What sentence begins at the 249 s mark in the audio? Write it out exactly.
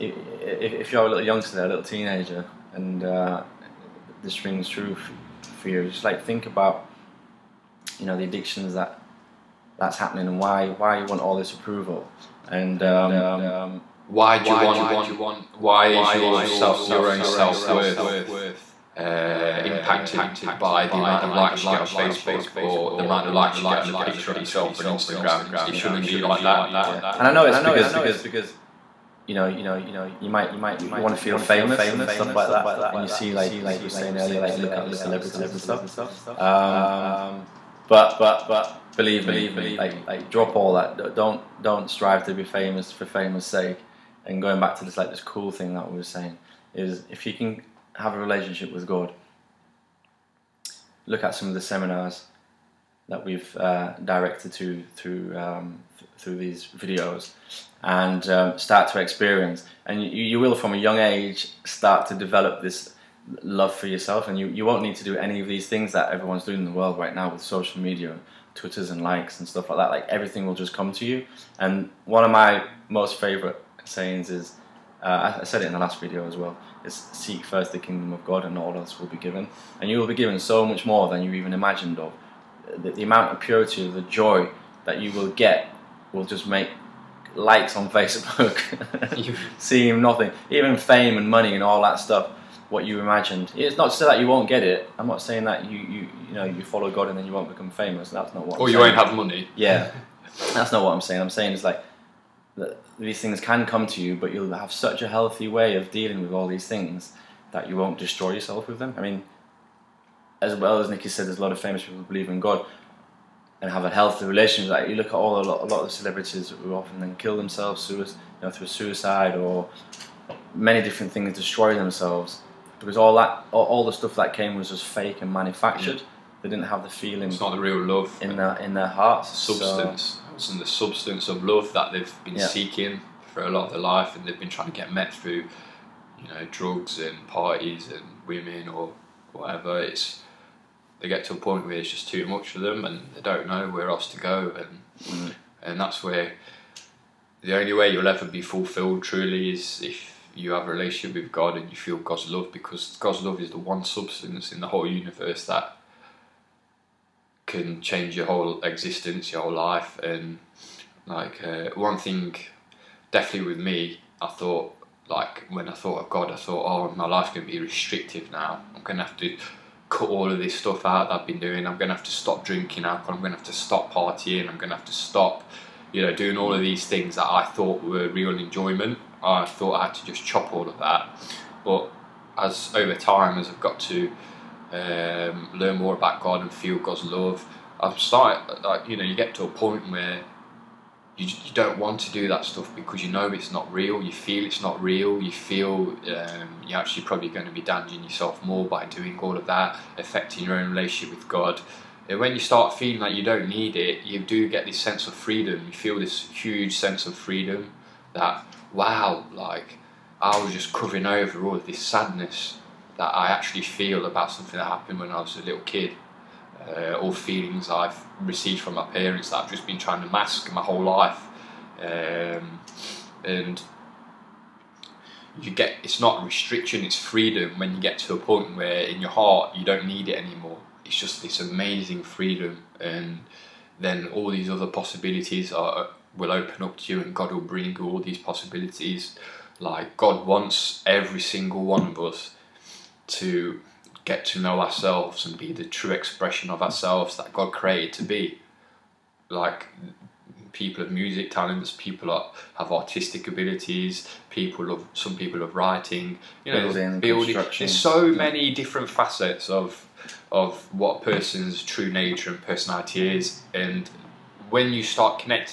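Like people of music talents, people are, have artistic abilities, people of some people of writing, you know, building, building.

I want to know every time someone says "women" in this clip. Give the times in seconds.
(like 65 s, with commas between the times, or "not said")
138 s.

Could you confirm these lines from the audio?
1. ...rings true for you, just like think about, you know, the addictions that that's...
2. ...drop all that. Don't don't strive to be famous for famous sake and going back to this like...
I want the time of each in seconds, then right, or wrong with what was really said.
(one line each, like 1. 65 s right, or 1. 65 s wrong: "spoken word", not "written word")
1. 4 s right
2. 40 s right.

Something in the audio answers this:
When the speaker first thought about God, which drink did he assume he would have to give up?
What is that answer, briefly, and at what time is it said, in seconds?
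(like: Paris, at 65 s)
alcohol, at 172 s.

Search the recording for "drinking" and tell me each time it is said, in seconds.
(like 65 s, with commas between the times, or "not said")
172 s.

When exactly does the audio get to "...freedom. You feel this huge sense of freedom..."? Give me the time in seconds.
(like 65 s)
205 s.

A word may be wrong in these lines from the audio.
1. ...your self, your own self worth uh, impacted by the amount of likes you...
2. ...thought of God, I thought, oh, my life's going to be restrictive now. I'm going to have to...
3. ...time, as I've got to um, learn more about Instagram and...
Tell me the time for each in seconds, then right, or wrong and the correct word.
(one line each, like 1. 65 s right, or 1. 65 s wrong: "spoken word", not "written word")
1. 16 s right
2. 165 s right
3. 182 s wrong: "God", not "Instagram".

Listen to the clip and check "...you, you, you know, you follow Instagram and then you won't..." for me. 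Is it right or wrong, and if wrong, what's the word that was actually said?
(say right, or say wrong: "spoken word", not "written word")
wrong: "God", not "Instagram".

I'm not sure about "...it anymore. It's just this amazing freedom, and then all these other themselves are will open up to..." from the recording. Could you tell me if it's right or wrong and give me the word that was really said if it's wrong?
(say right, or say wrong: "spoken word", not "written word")
wrong: "possibilities", not "themselves".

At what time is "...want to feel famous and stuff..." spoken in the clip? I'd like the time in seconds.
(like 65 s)
31 s.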